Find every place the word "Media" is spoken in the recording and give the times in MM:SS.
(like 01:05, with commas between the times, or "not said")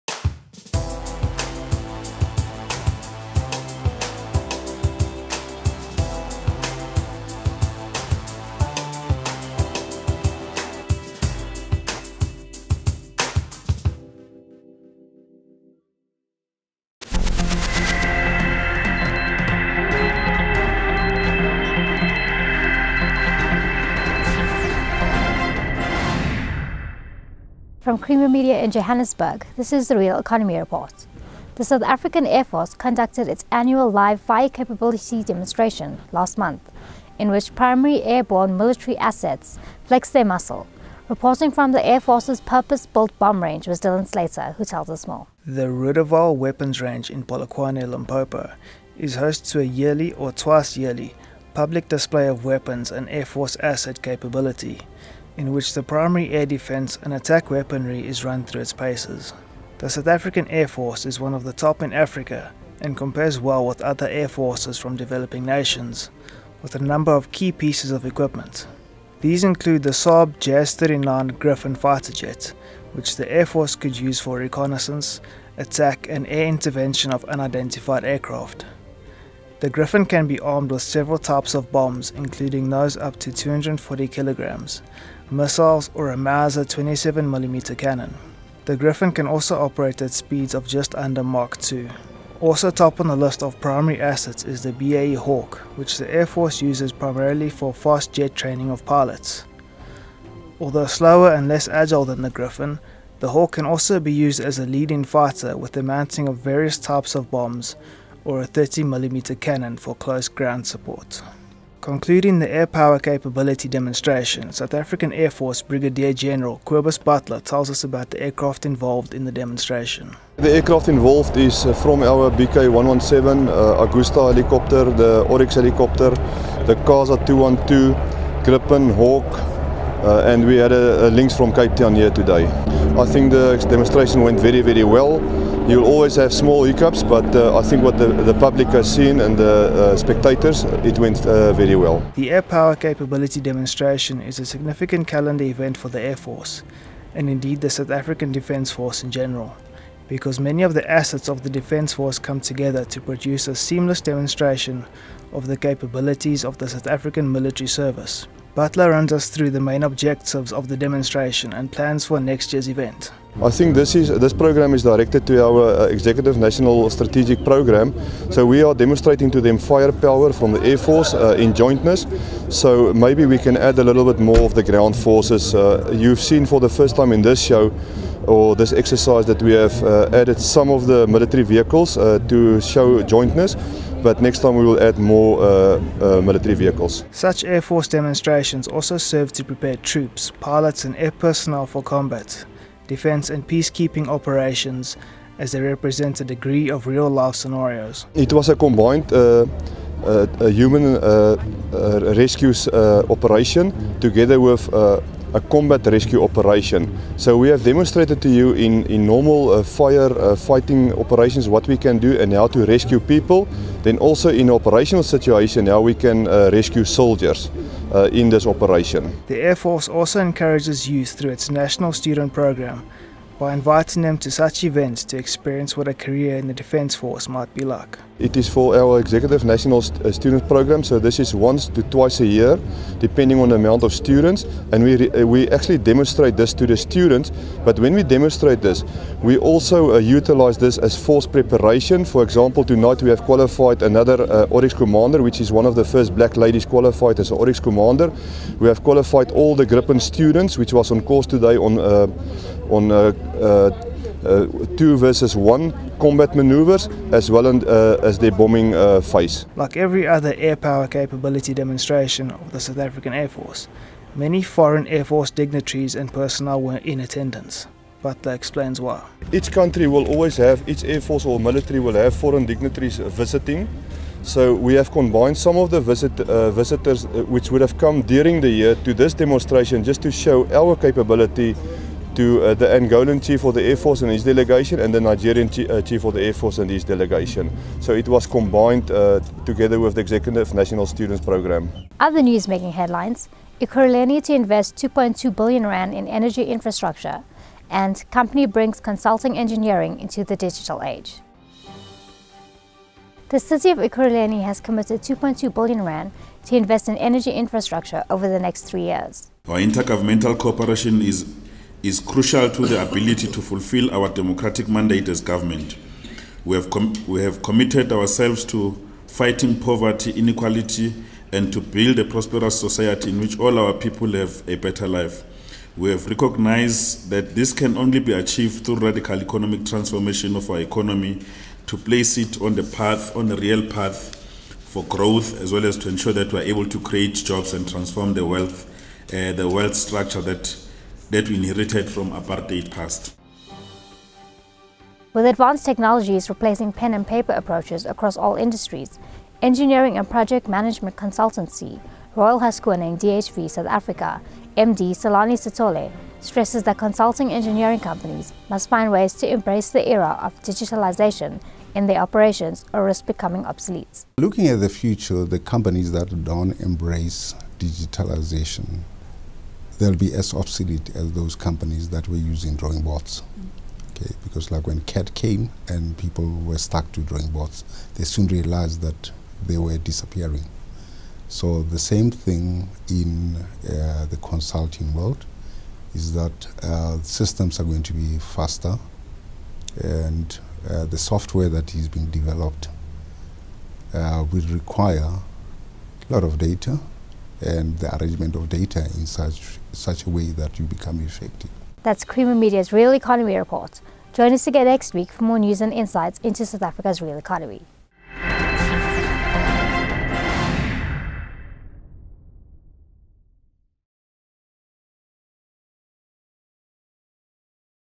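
00:28, 06:42.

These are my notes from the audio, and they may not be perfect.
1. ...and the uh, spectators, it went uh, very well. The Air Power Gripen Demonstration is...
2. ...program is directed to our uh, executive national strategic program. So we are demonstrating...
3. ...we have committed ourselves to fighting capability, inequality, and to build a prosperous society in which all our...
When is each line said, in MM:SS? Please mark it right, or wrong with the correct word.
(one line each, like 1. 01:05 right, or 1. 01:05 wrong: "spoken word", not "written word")
1. 02:19 wrong: "Capability", not "Gripen"
2. 02:44 right
3. 05:17 wrong: "poverty", not "capability".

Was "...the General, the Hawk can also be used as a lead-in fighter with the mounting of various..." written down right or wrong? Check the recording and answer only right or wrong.
wrong.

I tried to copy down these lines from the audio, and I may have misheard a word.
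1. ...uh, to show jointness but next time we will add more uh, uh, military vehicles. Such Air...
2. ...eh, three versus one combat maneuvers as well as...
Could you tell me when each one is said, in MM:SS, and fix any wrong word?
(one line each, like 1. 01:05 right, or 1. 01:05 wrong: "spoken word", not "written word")
1. 03:01 right
2. 04:14 wrong: "two", not "three".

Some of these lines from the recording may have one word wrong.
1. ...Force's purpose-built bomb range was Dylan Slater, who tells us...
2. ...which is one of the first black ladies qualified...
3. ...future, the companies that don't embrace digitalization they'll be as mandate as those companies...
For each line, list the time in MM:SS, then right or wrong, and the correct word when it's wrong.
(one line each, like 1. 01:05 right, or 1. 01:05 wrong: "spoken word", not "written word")
1. 00:41 right
2. 04:05 right
3. 06:04 wrong: "obsolete", not "mandate".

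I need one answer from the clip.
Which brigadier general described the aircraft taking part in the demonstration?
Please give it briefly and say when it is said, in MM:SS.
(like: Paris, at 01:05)
Kobus Butler, at 01:56.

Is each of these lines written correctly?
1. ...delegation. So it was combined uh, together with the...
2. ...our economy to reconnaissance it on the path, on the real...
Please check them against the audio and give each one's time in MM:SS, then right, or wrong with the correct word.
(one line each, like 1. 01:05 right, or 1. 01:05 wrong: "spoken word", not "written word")
1. 04:46 right
2. 05:30 wrong: "place", not "reconnaissance".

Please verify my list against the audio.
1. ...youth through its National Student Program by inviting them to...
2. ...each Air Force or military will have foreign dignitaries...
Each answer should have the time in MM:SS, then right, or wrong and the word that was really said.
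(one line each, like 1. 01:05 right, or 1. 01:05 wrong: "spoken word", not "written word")
1. 03:40 right
2. 04:30 right.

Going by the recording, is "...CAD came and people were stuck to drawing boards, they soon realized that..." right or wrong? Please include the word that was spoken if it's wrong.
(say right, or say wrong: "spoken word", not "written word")
right.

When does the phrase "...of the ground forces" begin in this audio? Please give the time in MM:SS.
02:54.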